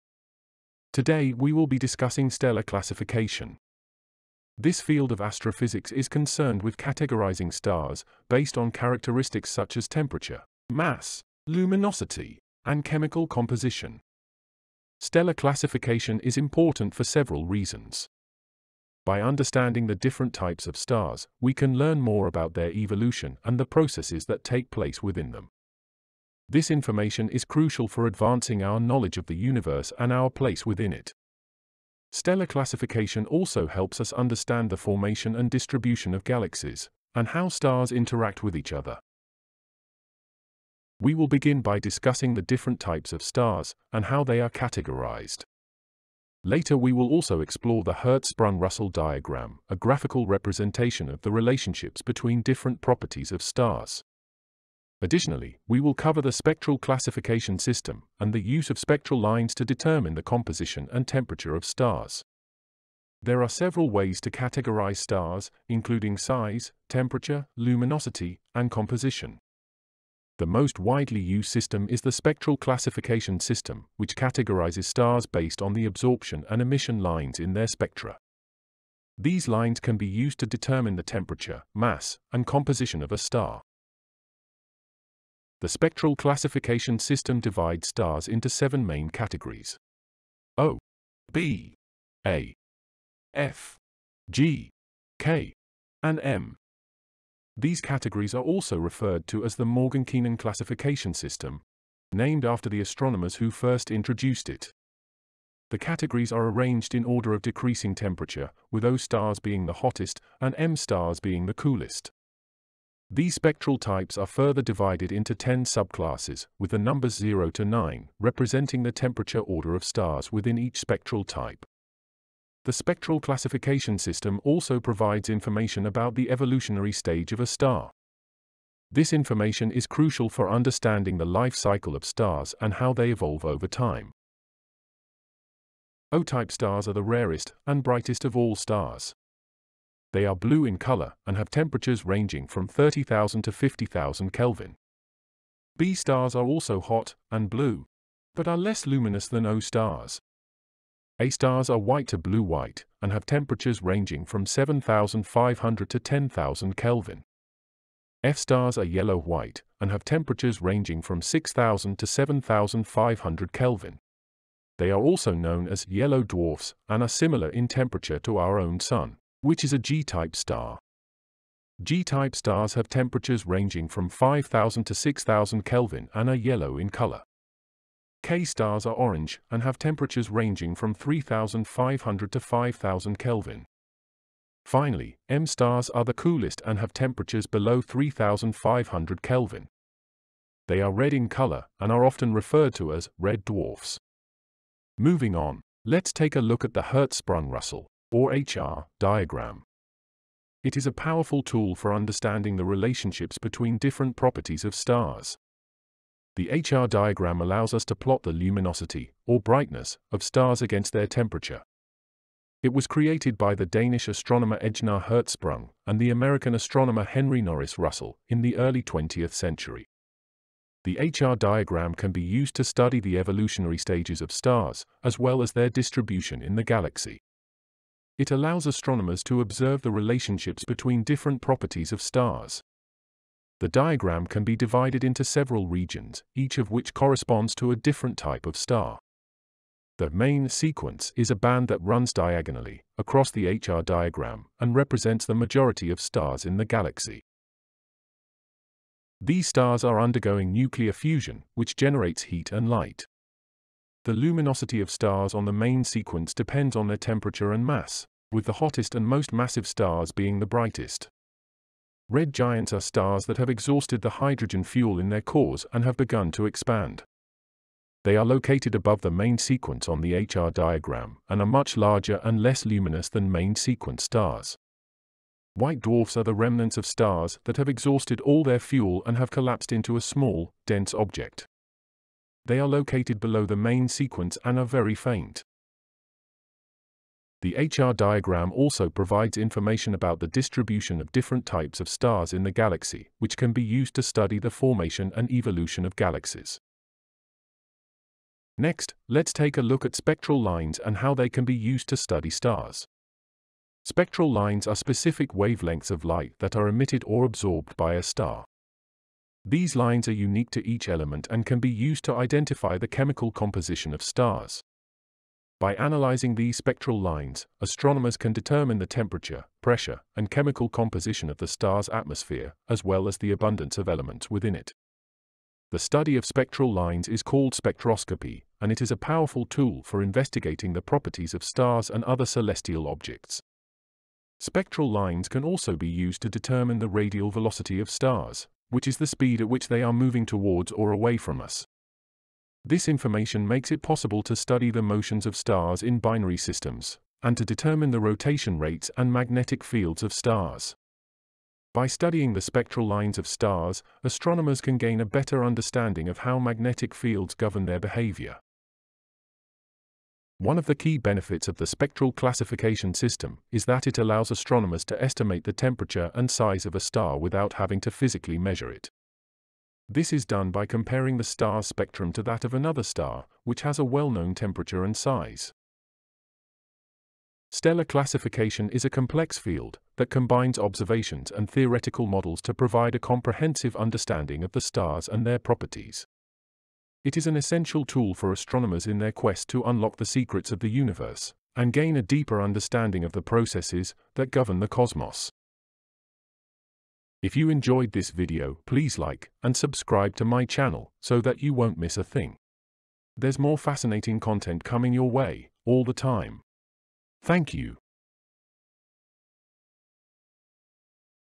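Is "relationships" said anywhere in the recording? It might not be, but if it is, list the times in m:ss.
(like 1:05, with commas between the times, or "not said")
0:51, 3:22, 3:49.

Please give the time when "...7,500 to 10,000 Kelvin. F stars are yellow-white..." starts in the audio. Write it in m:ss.
2:34.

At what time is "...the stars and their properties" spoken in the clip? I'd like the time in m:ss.
6:24.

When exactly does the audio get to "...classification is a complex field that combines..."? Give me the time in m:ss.
6:17.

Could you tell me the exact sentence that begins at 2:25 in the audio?
B stars are also hot and blue, but are less luminous than O stars.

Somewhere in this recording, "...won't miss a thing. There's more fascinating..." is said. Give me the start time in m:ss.
6:41.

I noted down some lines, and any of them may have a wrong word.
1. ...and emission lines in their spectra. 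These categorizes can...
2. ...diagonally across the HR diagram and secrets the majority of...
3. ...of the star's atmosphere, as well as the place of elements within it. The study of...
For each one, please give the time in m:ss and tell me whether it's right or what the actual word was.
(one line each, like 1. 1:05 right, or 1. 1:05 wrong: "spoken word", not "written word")
1. 1:16 wrong: "lines", not "categorizes"
2. 4:02 wrong: "represents", not "secrets"
3. 5:21 wrong: "abundance", not "place".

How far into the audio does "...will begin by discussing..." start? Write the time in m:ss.
0:41.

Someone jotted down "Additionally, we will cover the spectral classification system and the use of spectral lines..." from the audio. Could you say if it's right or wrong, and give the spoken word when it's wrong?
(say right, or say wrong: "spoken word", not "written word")
right.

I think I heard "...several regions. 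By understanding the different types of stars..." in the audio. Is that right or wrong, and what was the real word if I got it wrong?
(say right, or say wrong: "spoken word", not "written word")
wrong: "reasons", not "regions".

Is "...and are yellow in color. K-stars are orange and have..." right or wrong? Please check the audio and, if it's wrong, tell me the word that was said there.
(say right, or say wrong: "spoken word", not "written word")
right.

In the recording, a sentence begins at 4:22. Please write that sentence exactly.
Red giants are stars that have exhausted the hydrogen fuel in their cores and have begun to expand.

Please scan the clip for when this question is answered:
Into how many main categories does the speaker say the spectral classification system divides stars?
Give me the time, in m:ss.
1:28.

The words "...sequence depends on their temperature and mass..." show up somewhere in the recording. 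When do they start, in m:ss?
4:15.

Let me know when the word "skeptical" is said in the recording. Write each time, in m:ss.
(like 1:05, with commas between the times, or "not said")
not said.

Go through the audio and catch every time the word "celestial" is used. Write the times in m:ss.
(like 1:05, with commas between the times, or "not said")
5:32.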